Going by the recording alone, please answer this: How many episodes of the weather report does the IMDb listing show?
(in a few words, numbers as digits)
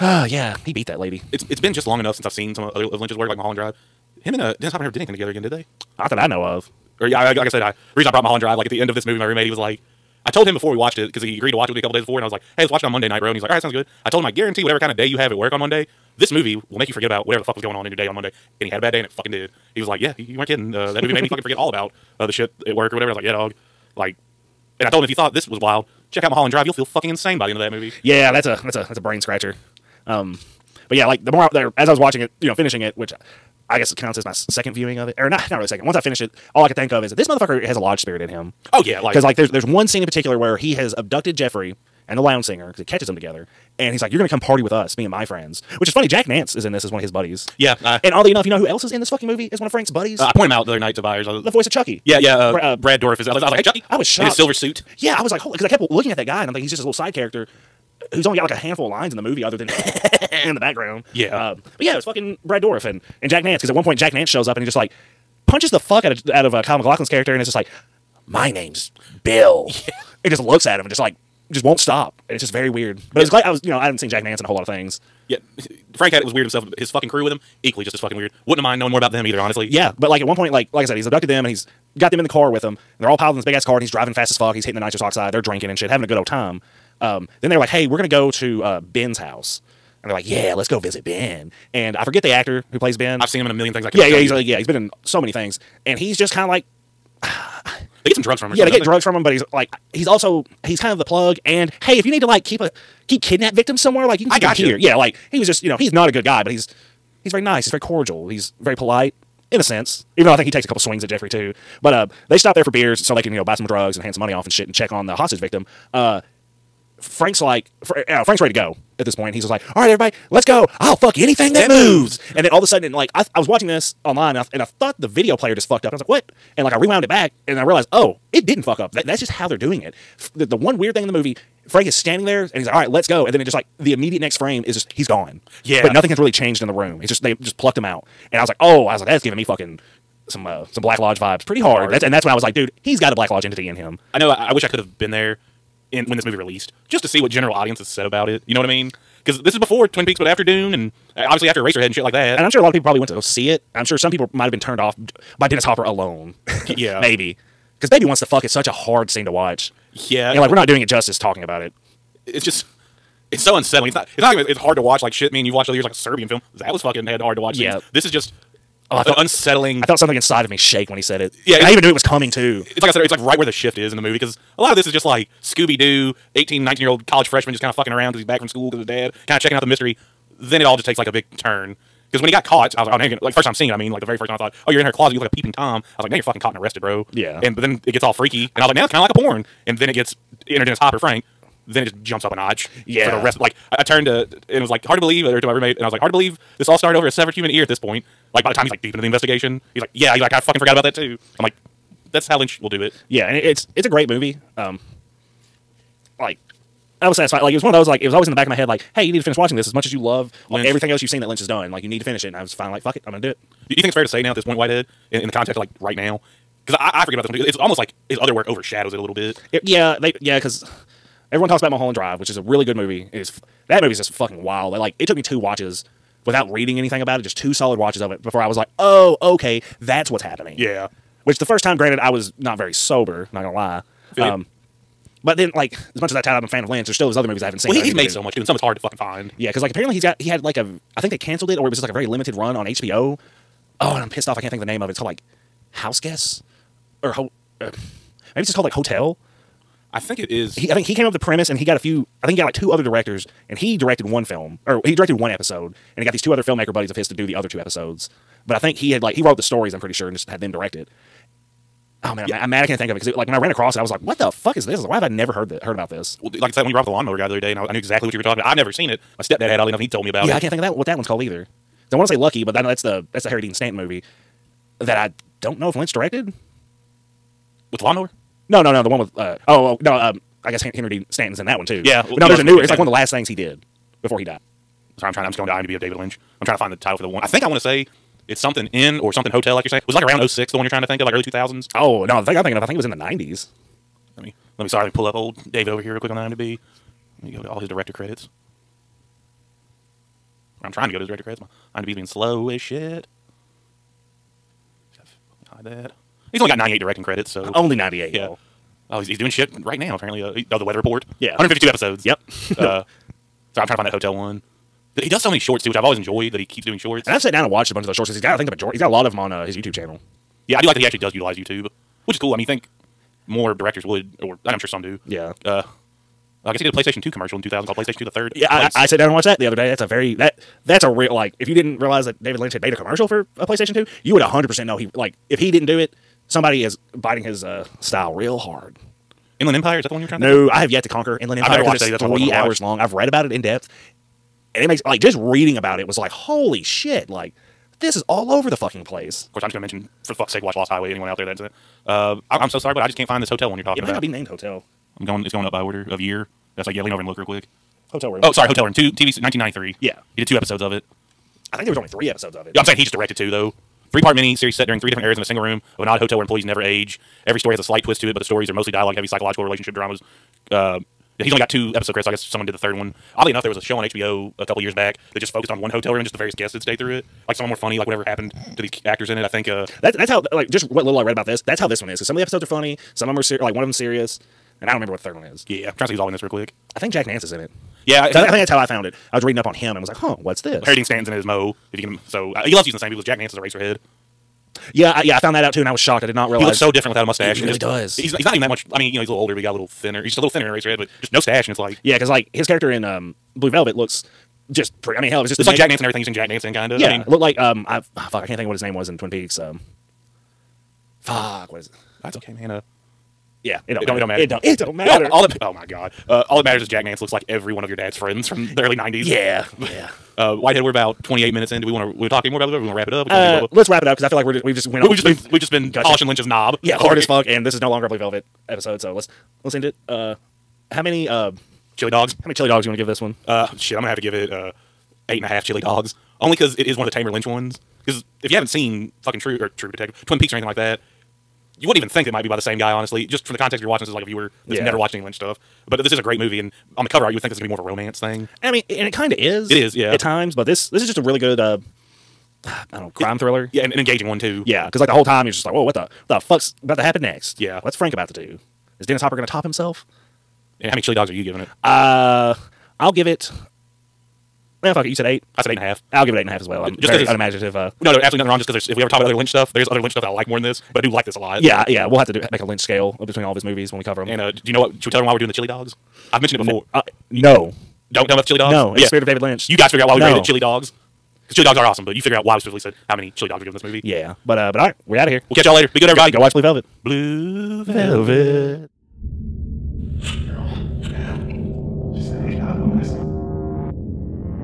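152.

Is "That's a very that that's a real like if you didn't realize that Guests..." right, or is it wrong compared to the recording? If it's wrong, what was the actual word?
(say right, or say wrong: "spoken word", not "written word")
wrong: "David", not "Guests".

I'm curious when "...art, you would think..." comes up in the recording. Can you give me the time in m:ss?
7:27.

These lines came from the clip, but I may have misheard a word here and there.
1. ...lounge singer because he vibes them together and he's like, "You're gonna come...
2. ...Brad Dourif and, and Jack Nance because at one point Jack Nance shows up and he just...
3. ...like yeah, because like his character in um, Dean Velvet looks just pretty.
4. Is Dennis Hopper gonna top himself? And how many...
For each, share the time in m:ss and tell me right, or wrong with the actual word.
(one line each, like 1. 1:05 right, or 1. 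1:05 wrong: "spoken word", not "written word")
1. 0:42 wrong: "catches", not "vibes"
2. 1:02 right
3. 6:41 wrong: "Blue", not "Dean"
4. 7:38 right.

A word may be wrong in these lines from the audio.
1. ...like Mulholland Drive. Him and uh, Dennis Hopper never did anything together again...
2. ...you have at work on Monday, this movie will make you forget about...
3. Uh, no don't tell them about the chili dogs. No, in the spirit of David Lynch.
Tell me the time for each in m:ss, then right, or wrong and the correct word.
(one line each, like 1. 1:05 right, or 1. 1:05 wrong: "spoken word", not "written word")
1. 0:03 right
2. 0:15 right
3. 7:56 right.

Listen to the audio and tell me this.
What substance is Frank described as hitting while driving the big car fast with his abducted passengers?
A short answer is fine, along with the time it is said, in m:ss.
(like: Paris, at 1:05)
nitrous oxide, at 1:24.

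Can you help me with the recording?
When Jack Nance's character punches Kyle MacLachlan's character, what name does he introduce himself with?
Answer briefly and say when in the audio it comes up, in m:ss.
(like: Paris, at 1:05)
Bill, at 1:08.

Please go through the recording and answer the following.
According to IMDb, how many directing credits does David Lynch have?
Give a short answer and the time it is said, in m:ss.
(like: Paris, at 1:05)
98, at 5:06.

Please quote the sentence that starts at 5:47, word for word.
Like this is all over the fucking place.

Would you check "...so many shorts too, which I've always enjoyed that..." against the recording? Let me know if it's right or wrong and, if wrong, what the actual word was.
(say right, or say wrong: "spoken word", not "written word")
right.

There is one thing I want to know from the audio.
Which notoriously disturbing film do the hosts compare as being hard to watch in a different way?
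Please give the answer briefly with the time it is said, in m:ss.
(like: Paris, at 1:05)
A Serbian Film, at 2:45.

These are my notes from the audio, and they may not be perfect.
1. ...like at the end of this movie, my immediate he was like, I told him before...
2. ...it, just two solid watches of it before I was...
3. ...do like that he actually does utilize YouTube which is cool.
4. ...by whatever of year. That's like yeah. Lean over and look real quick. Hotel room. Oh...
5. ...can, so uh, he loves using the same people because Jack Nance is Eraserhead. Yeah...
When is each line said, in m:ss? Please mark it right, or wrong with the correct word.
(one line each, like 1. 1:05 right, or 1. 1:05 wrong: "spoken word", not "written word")
1. 0:08 wrong: "roommate", not "immediate"
2. 3:47 right
3. 5:20 right
4. 5:55 wrong: "order", not "whatever"
5. 6:31 right.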